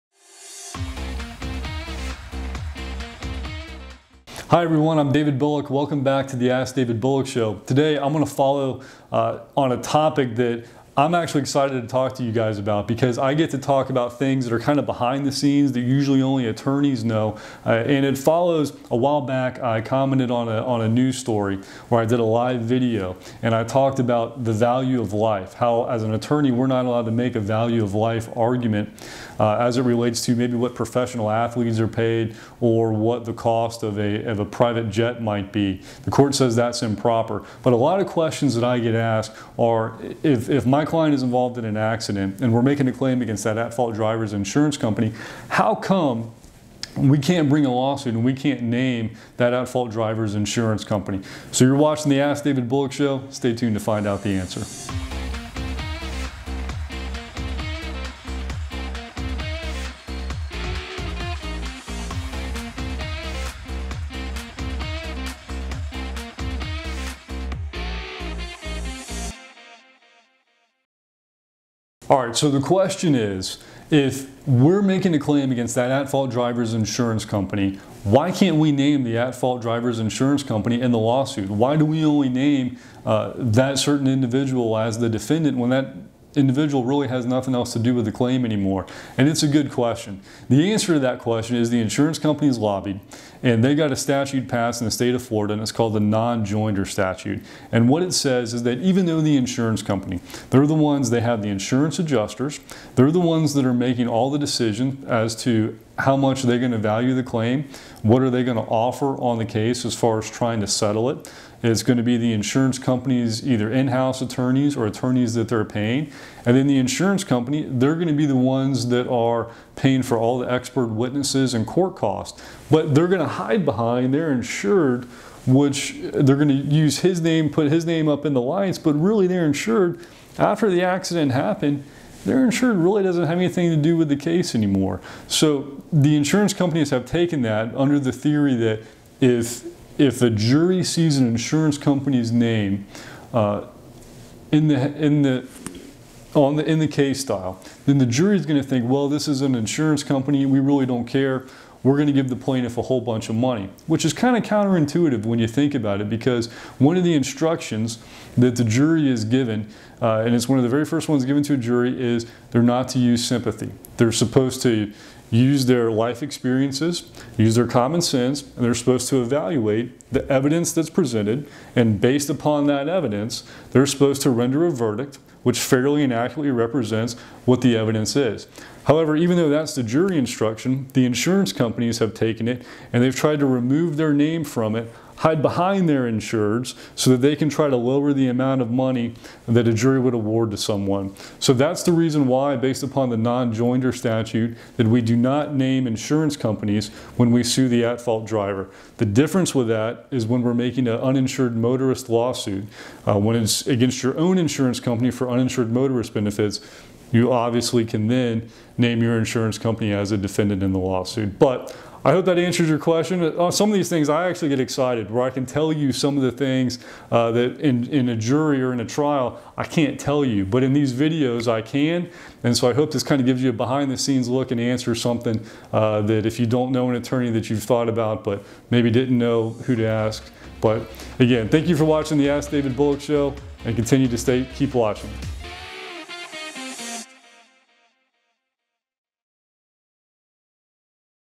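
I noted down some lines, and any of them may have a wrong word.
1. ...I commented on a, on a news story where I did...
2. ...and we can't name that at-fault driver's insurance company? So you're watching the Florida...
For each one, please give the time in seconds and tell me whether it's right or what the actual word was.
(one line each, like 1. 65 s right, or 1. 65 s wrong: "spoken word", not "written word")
1. 19 s right
2. 48 s wrong: "Ask", not "Florida".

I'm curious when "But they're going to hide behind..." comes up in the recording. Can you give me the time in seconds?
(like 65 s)
122 s.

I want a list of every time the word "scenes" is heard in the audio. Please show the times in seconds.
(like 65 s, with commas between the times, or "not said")
15 s, 223 s.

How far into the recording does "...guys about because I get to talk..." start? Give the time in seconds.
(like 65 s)
12 s.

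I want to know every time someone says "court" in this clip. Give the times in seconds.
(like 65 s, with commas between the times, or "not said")
36 s, 121 s.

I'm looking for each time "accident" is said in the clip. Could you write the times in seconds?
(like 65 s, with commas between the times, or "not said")
41 s, 130 s.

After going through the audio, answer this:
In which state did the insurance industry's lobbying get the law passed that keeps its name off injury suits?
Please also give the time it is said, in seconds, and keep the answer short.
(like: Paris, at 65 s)
Florida, at 95 s.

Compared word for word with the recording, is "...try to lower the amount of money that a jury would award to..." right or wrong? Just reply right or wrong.
right.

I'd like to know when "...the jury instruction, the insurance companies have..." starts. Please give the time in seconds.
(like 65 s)
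179 s.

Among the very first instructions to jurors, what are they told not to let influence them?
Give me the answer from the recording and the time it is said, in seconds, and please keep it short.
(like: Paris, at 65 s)
sympathy, at 163 s.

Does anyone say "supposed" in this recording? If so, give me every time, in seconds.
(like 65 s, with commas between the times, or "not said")
164 s, 168 s, 173 s.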